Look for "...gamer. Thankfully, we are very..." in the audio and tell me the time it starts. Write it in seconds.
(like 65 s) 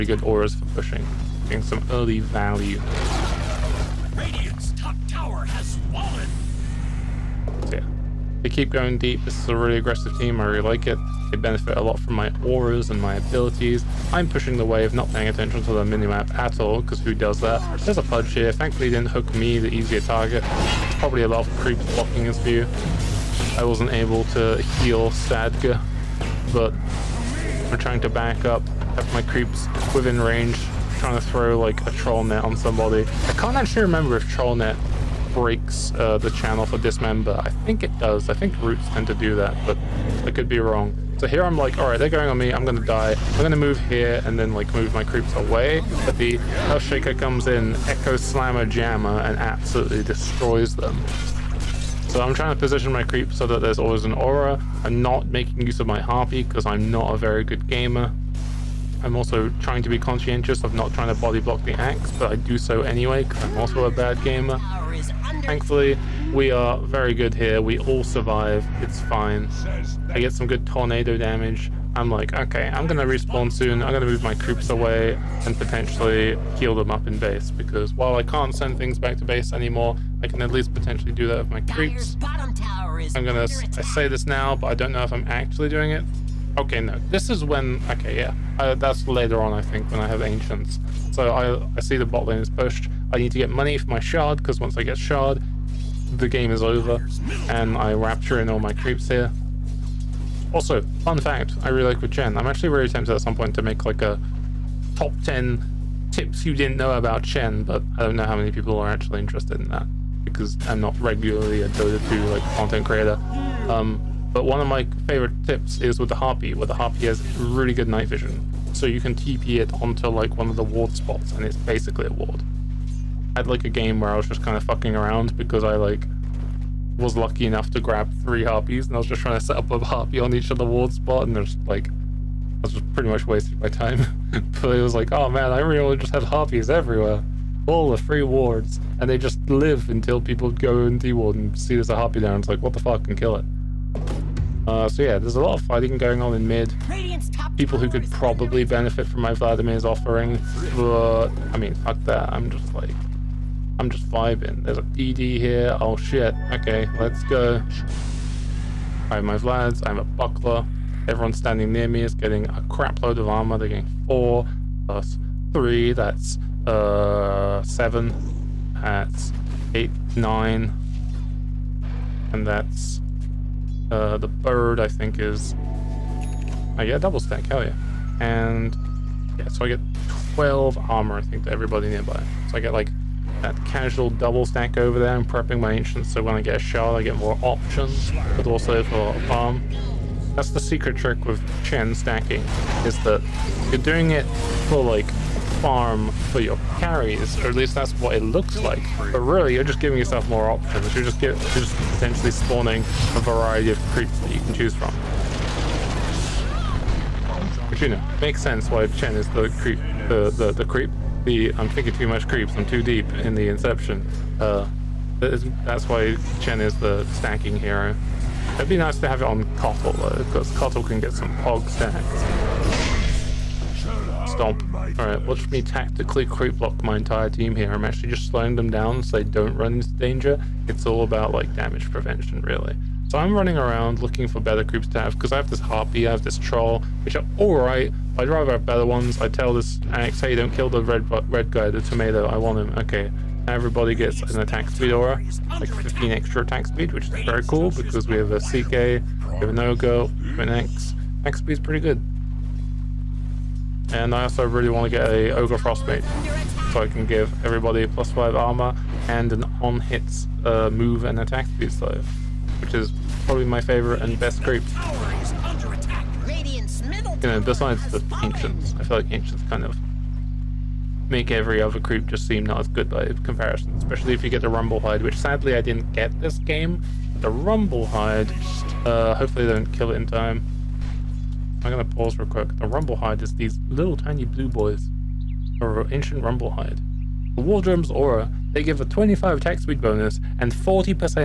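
64 s.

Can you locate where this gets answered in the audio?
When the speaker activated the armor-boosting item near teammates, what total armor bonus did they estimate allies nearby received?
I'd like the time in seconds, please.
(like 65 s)
180 s.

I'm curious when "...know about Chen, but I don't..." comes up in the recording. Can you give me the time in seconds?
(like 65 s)
106 s.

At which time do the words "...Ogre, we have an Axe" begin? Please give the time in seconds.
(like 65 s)
249 s.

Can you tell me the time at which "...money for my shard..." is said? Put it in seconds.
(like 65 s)
93 s.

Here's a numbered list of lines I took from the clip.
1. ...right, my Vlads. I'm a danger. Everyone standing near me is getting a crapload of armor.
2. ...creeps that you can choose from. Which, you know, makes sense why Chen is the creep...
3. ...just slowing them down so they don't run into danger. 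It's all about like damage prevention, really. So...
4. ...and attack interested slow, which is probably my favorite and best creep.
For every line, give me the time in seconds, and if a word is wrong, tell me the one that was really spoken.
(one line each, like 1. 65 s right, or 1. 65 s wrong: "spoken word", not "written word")
1. 159 s wrong: "buckler", not "danger"
2. 203 s right
3. 228 s right
4. 261 s wrong: "speed", not "interested".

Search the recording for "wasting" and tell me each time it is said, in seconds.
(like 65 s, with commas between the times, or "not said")
133 s.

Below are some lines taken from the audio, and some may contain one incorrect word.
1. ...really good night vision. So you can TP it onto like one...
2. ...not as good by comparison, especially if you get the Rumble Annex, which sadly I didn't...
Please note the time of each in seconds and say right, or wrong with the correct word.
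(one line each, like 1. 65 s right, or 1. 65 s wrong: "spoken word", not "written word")
1. 117 s right
2. 272 s wrong: "Hide", not "Annex".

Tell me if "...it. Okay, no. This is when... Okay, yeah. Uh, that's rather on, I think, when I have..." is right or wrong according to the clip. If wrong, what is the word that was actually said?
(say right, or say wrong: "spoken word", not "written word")
wrong: "later", not "rather".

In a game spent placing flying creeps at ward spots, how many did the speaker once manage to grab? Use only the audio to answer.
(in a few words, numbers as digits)
3.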